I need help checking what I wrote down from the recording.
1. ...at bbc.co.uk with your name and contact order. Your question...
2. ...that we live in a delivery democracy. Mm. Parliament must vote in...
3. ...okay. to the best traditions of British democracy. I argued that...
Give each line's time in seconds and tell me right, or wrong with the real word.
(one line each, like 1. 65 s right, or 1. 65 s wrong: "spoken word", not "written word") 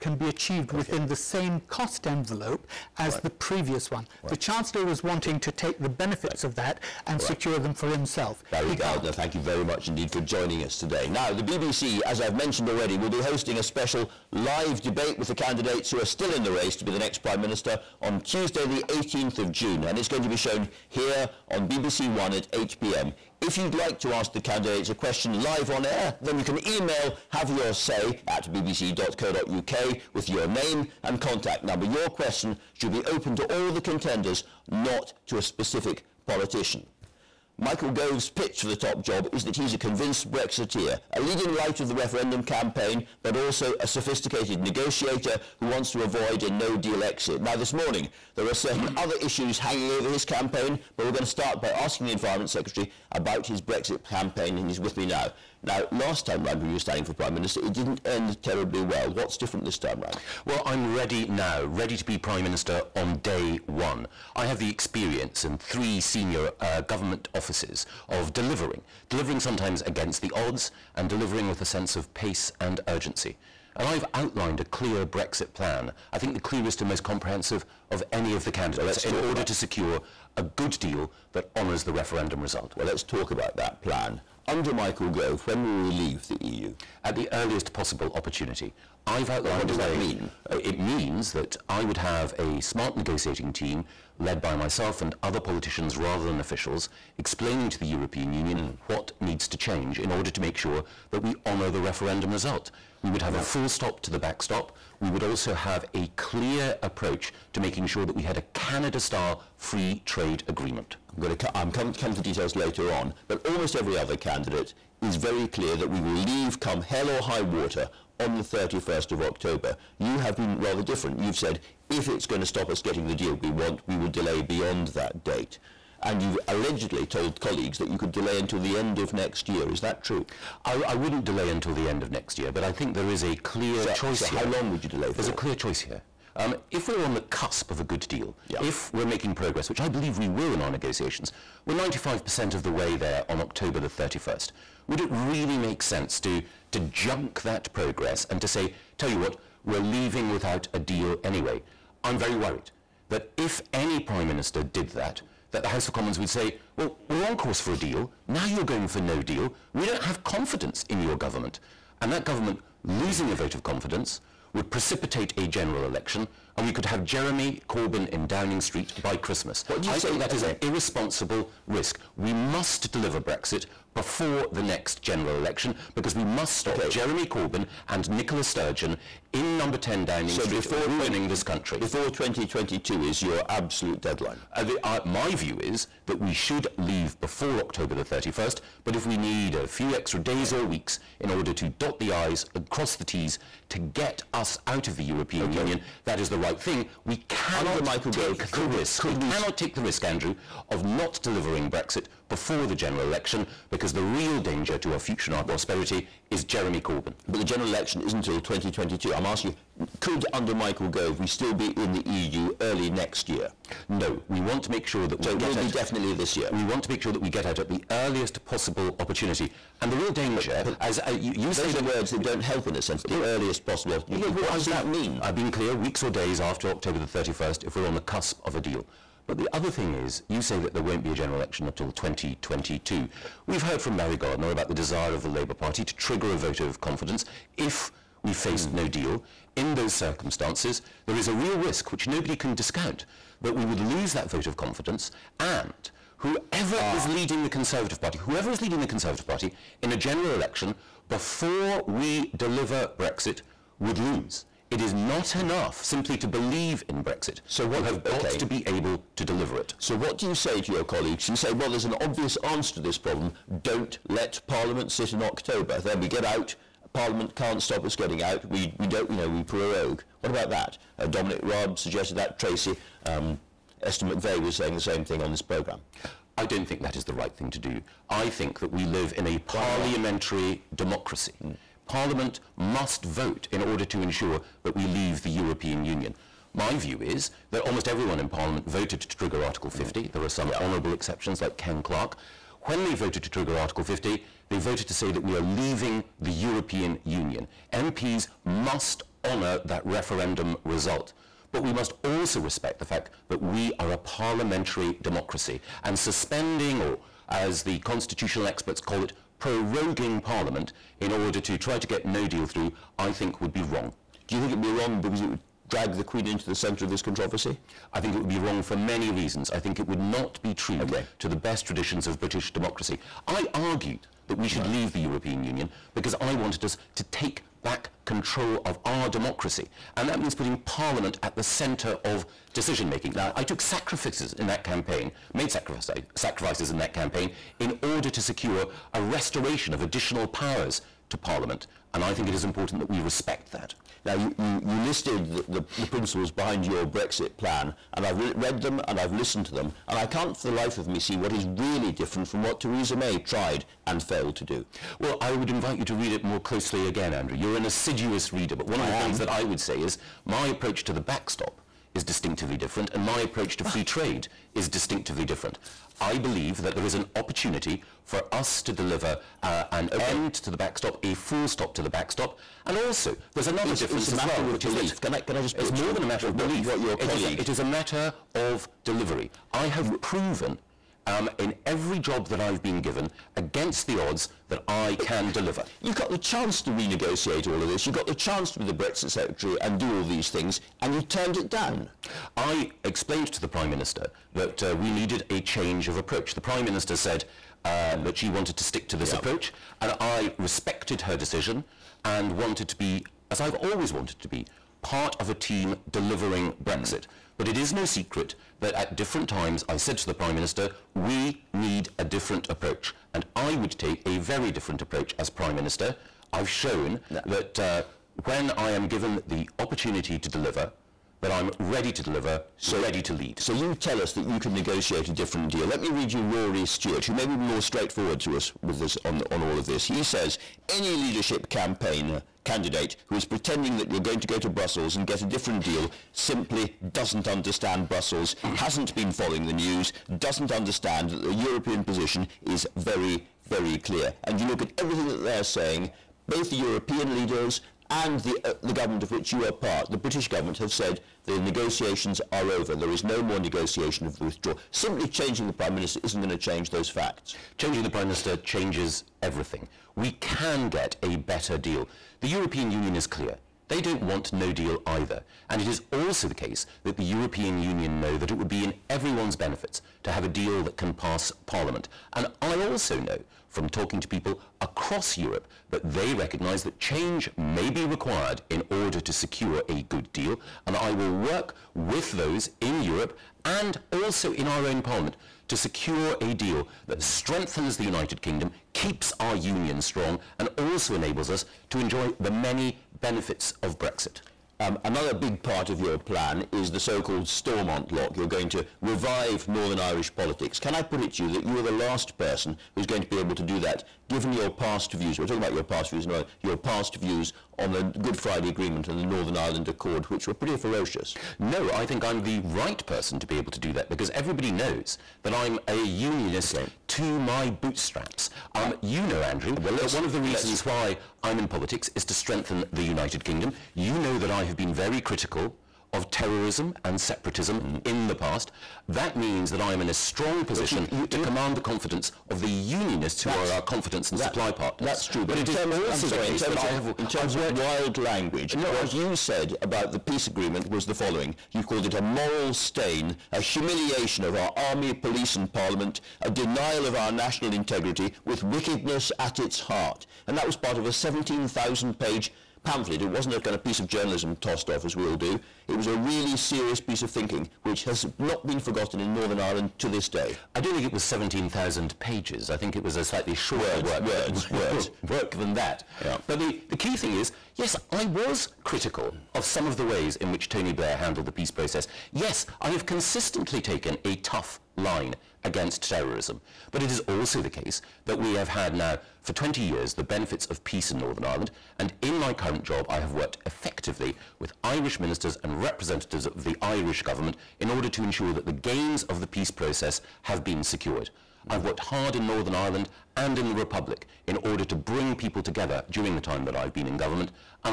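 1. 28 s wrong: "number", not "order"
2. 278 s wrong: "parliamentary", not "delivery"
3. 320 s right.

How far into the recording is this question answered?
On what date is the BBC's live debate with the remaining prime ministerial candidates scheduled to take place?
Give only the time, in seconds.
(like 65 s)
18 s.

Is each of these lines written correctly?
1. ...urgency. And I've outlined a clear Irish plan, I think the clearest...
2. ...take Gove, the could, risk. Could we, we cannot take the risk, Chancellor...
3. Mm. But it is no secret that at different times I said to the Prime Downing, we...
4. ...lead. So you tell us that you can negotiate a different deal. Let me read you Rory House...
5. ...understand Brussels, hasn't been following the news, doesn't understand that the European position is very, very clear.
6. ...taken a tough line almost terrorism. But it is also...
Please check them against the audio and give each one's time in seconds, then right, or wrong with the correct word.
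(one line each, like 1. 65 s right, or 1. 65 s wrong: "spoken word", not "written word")
1. 72 s wrong: "Brexit", not "Irish"
2. 197 s wrong: "Andrew", not "Chancellor"
3. 407 s wrong: "Minister", not "Downing"
4. 423 s wrong: "Stewart", not "House"
5. 437 s right
6. 573 s wrong: "against", not "almost".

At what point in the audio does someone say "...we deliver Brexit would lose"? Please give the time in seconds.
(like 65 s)
251 s.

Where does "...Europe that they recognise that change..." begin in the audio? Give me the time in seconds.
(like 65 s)
475 s.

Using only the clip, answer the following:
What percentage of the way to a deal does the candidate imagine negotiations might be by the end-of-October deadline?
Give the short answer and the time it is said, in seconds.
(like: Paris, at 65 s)
95%, at 141 s.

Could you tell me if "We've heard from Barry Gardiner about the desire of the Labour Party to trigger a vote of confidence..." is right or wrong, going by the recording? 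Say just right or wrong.
right.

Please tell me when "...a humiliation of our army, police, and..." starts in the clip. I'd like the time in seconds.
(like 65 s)
543 s.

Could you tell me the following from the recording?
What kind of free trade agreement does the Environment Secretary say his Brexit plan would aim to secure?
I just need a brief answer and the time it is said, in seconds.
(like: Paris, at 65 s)
Canada style, at 108 s.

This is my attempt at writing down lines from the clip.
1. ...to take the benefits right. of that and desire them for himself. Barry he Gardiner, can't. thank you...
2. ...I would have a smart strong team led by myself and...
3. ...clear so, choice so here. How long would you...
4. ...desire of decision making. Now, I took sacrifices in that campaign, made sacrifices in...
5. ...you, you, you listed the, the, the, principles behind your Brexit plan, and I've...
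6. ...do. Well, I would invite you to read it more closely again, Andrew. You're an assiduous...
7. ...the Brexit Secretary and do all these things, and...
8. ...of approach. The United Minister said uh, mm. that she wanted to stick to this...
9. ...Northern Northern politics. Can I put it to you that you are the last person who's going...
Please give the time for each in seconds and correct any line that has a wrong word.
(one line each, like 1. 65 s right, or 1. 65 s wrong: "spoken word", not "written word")
1. 5 s wrong: "secure", not "desire"
2. 91 s wrong: "negotiating", not "strong"
3. 133 s right
4. 331 s wrong: "centre", not "desire"
5. 344 s right
6. 354 s right
7. 388 s right
8. 395 s wrong: "Prime", not "United"
9. 499 s wrong: "Irish", not "Northern".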